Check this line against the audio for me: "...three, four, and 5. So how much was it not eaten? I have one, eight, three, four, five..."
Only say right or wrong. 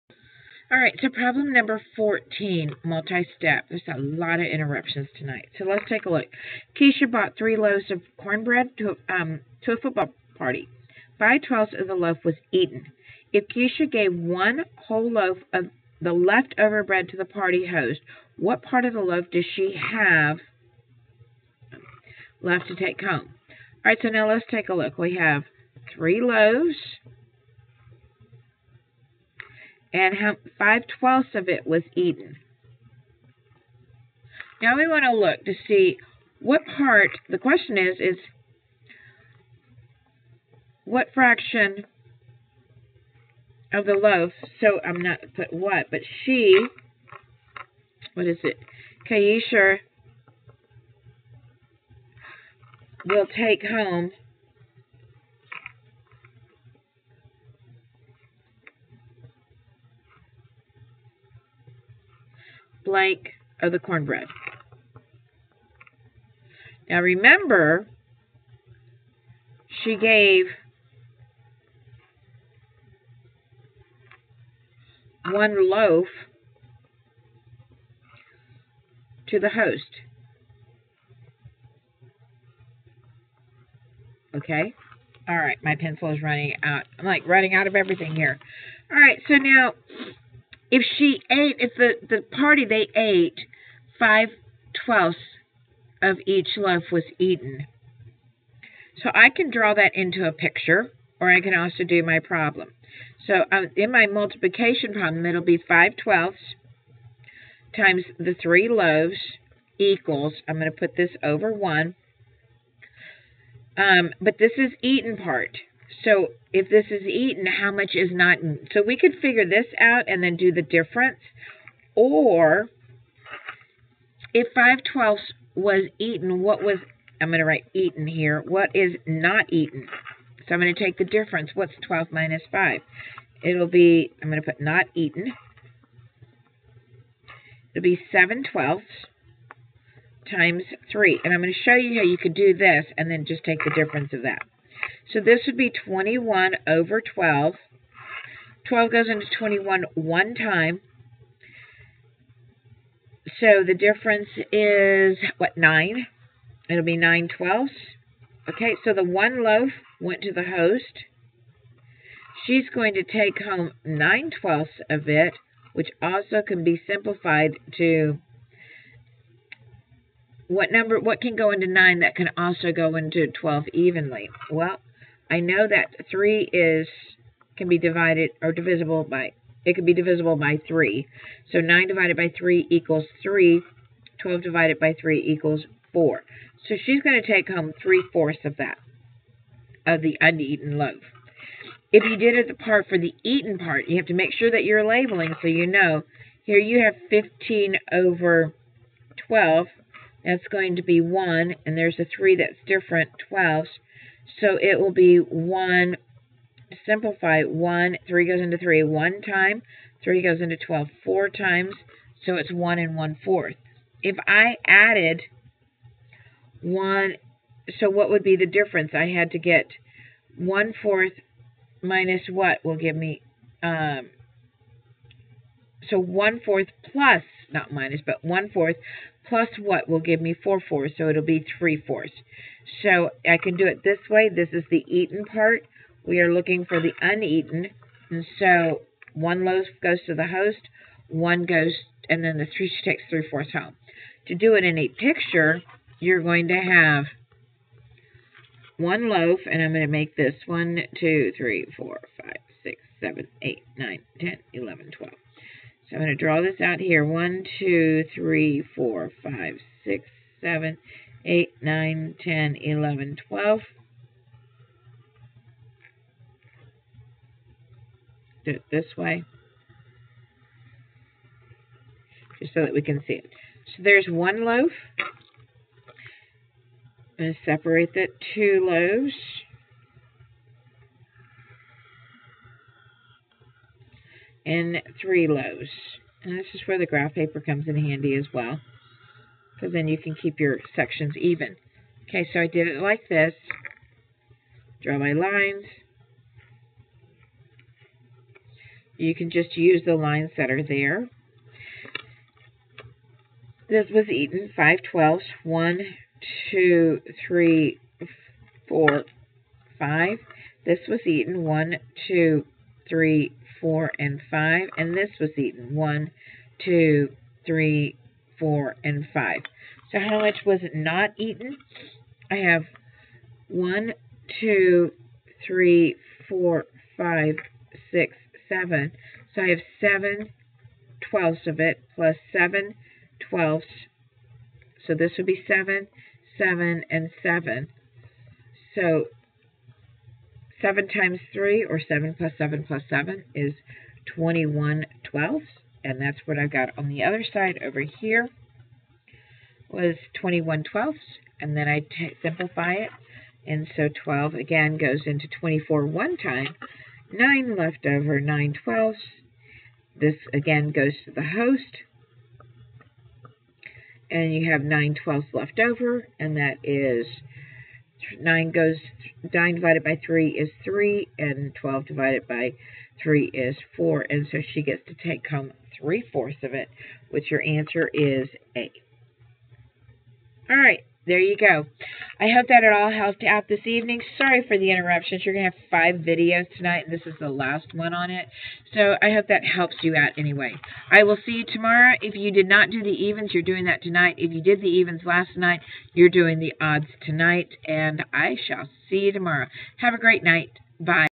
wrong.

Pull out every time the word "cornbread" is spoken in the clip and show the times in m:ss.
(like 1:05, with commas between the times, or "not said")
0:08, 1:03.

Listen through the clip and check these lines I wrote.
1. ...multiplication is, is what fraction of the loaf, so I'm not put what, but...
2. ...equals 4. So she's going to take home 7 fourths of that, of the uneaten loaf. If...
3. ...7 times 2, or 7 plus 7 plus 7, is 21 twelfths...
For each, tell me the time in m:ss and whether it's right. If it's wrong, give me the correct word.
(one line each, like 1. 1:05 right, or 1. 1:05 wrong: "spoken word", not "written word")
1. 0:37 wrong: "question", not "multiplication"
2. 3:05 wrong: "3", not "7"
3. 5:40 wrong: "3", not "2".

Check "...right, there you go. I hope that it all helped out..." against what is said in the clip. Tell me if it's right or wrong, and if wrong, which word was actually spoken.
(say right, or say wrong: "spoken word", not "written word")
right.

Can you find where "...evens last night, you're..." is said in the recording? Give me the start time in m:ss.
6:34.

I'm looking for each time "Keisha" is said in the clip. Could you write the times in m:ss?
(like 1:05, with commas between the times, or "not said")
0:06, 0:13, 0:49.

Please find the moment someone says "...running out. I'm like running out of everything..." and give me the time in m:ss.
1:26.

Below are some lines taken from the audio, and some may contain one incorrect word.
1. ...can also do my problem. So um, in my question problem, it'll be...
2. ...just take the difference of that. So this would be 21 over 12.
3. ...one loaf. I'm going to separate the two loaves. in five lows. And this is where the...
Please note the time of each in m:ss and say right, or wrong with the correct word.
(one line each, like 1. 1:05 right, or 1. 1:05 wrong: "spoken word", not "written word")
1. 1:41 wrong: "multiplication", not "question"
2. 2:23 right
3. 4:34 wrong: "three", not "five".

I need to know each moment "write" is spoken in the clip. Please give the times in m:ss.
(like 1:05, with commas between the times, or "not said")
2:07.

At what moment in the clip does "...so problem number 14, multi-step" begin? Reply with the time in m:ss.
0:01.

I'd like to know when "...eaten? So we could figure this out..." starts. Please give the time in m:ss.
1:58.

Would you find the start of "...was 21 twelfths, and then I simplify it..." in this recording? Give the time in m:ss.
5:49.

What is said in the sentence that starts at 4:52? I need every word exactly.
Okay, so I did it like this.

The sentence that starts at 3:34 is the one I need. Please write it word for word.
If I added 1, so what would be the difference?